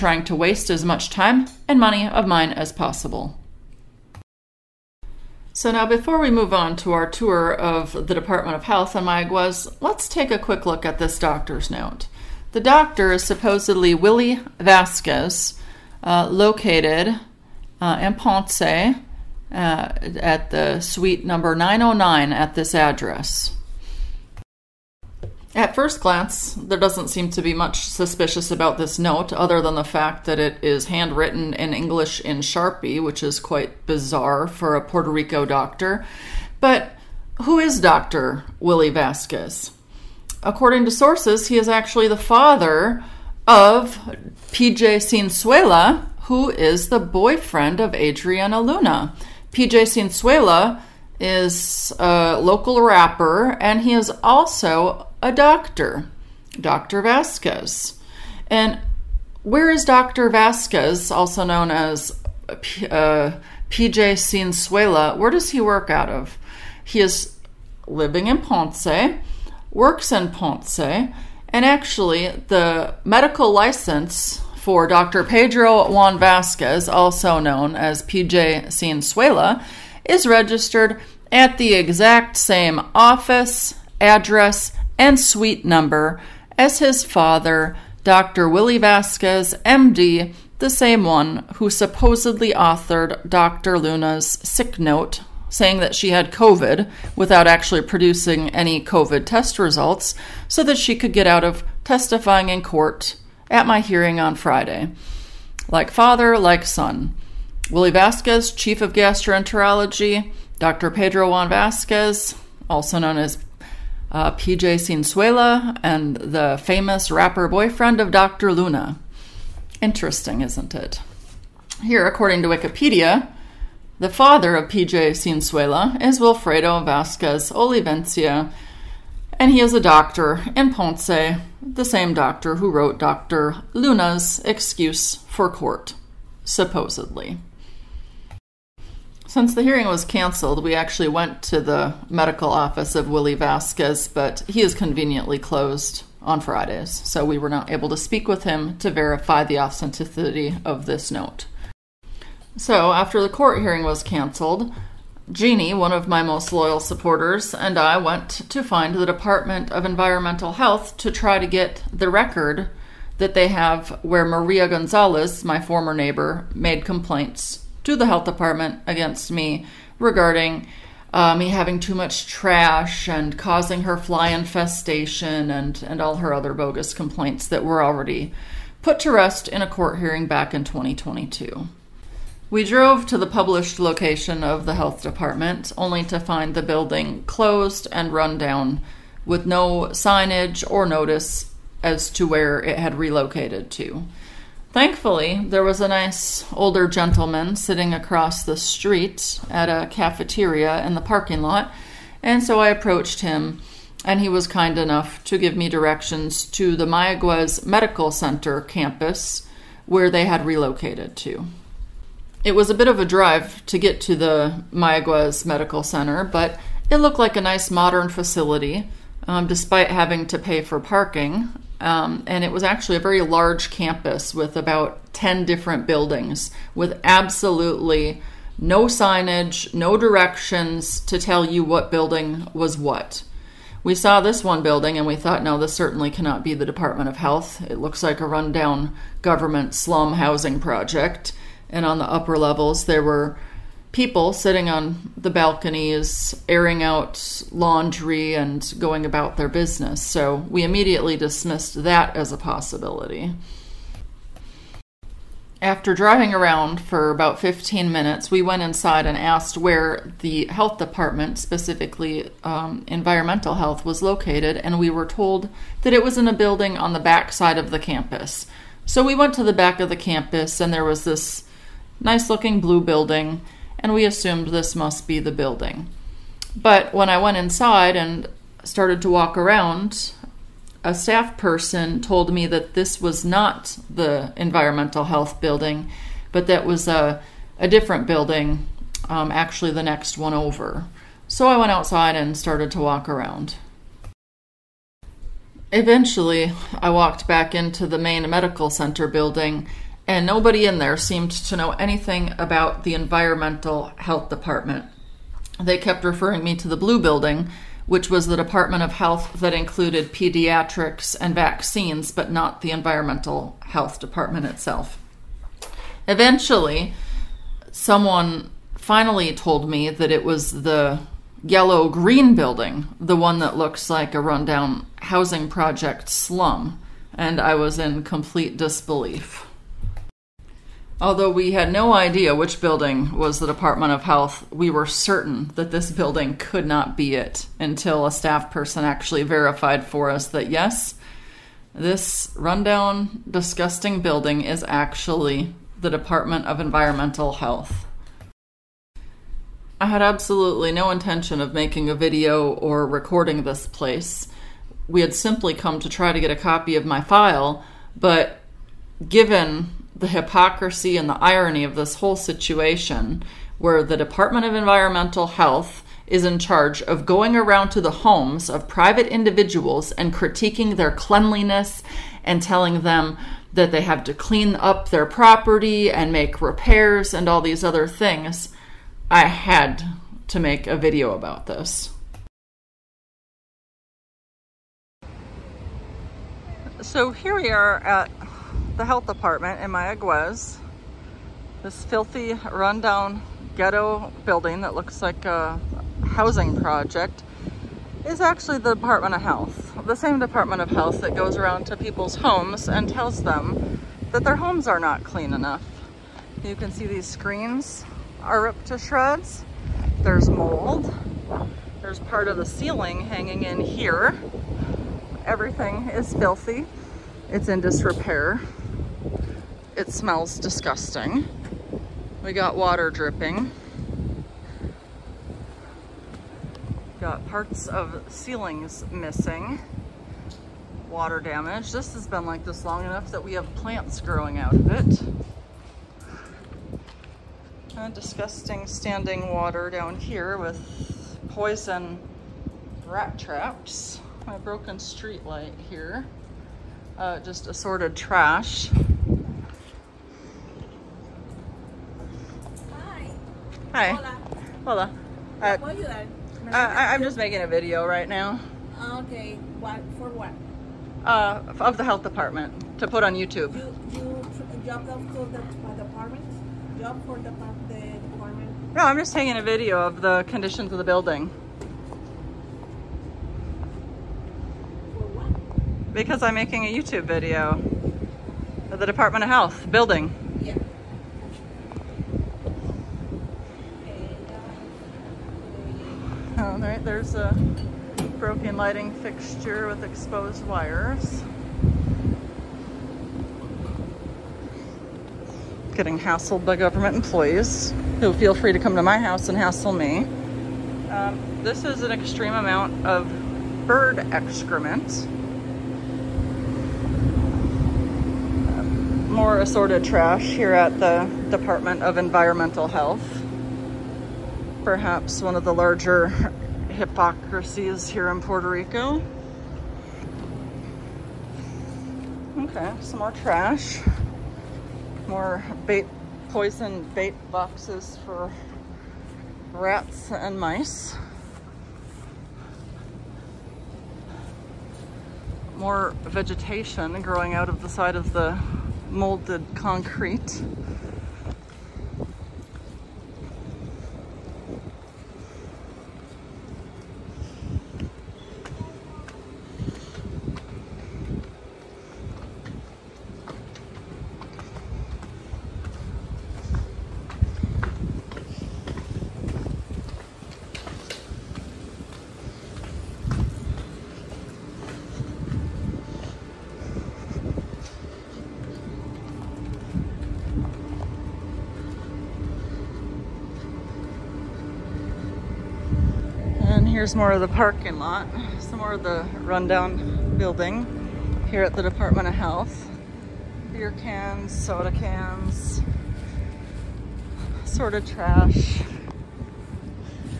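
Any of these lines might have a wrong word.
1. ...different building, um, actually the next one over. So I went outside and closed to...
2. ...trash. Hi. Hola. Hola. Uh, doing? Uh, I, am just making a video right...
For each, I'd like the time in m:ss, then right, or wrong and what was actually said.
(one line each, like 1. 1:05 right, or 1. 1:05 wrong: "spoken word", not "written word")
1. 4:47 wrong: "started", not "closed"
2. 7:27 right.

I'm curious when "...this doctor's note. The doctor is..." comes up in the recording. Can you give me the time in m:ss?
0:10.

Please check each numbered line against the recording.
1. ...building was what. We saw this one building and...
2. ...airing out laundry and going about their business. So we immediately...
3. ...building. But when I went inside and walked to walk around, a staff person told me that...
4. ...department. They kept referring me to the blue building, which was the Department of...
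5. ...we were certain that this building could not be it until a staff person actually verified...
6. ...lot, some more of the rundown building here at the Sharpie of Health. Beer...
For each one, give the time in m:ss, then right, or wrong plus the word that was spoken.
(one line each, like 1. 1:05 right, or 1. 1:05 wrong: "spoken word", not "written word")
1. 3:51 right
2. 4:06 right
3. 4:35 wrong: "started", not "walked"
4. 5:04 right
5. 5:34 right
6. 9:37 wrong: "Department", not "Sharpie".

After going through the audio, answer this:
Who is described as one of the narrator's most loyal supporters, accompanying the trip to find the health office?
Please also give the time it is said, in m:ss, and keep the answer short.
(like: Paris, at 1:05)
Jeannie, at 2:35.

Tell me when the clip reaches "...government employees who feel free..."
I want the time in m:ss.
8:16.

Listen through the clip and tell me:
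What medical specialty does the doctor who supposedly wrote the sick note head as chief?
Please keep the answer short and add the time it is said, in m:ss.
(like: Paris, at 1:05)
Gastroenterology, at 1:48.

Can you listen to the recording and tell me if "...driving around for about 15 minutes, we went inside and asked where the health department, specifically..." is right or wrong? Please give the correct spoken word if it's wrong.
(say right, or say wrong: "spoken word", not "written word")
right.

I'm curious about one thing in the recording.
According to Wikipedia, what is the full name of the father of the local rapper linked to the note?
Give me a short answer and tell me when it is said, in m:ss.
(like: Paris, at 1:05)
Wilfredo Vasquez Olivencia, at 2:06.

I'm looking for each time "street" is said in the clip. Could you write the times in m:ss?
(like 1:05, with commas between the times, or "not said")
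3:18, 7:24.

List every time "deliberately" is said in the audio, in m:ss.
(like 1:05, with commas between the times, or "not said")
not said.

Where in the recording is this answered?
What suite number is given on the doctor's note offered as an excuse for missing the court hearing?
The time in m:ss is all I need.
0:21.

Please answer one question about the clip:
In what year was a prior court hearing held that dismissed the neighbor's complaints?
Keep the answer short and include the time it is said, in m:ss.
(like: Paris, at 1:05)
2022, at 3:00.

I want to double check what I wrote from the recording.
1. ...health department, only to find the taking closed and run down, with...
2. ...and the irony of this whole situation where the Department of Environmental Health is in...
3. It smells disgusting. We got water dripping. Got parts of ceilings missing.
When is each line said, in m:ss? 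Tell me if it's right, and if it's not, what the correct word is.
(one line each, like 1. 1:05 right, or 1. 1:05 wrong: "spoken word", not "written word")
1. 3:04 wrong: "building", not "taking"
2. 6:00 right
3. 6:59 right.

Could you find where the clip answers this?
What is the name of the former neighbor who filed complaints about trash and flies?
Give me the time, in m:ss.
2:44.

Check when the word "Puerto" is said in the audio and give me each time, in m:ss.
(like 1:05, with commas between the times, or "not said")
0:34, 8:38.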